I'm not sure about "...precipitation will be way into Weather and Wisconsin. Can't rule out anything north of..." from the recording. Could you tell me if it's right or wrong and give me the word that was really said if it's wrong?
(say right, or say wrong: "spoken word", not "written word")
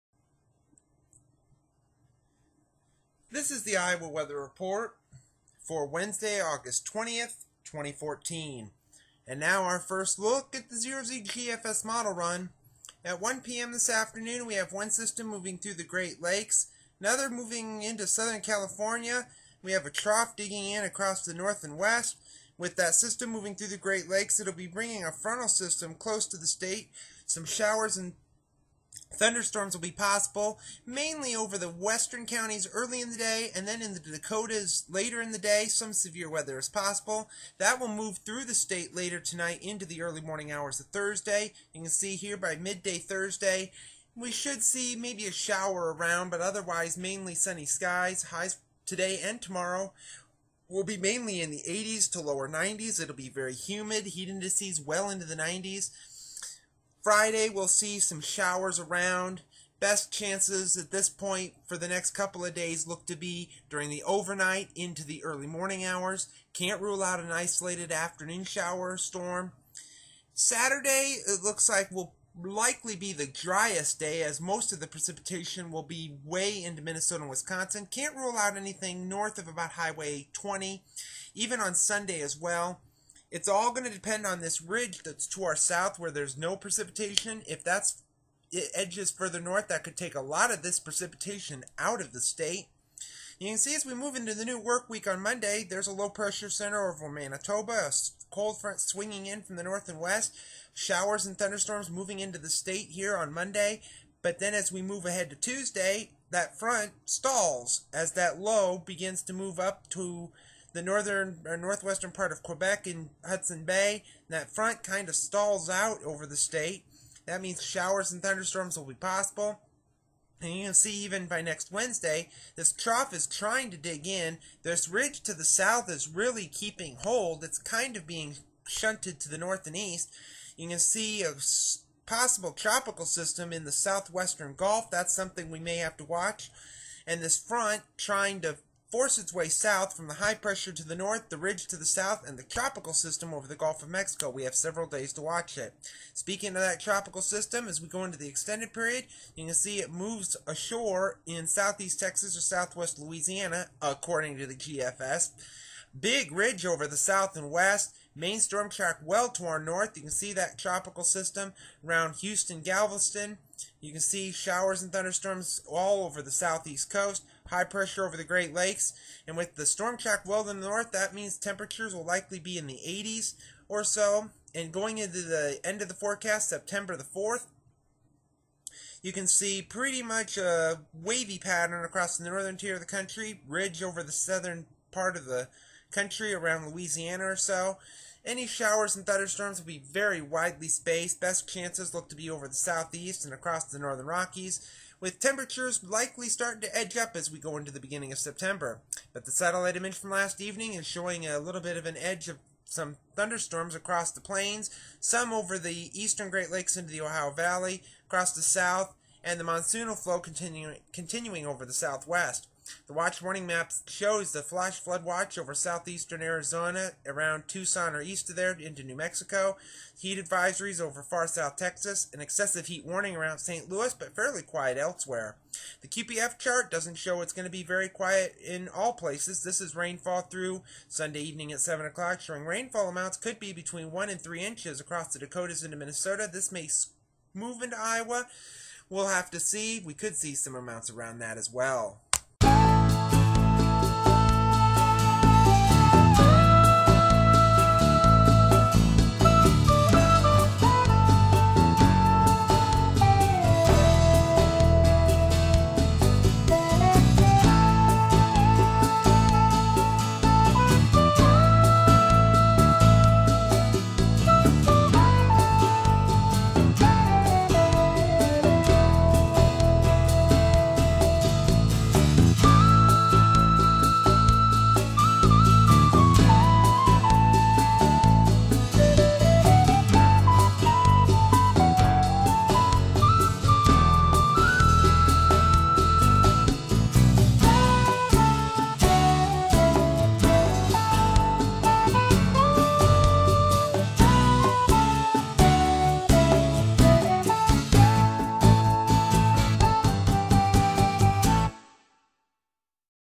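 wrong: "Minnesota", not "Weather".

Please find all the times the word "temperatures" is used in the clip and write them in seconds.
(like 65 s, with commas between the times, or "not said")
171 s, 195 s.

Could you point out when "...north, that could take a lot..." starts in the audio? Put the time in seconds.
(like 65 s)
89 s.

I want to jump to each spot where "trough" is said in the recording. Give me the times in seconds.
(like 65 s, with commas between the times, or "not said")
19 s, 122 s.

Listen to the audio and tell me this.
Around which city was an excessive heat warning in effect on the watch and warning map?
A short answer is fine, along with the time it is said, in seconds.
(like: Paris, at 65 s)
St. Louis, at 223 s.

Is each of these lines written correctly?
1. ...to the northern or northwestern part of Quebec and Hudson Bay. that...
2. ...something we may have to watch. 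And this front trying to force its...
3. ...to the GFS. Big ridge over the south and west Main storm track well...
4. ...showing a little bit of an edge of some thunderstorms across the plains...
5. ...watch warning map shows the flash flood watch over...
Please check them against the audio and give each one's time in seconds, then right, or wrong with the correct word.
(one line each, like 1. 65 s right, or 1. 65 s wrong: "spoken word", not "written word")
1. 109 s right
2. 135 s right
3. 154 s right
4. 200 s right
5. 212 s right.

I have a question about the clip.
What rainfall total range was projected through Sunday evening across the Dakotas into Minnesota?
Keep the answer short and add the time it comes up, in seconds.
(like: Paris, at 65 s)
1 to 3 inches, at 233 s.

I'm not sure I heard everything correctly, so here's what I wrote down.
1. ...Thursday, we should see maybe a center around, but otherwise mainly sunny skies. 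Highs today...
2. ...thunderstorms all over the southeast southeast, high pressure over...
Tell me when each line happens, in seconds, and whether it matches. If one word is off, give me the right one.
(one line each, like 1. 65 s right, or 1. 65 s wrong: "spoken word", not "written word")
1. 42 s wrong: "shower", not "center"
2. 164 s wrong: "coast", not "southeast".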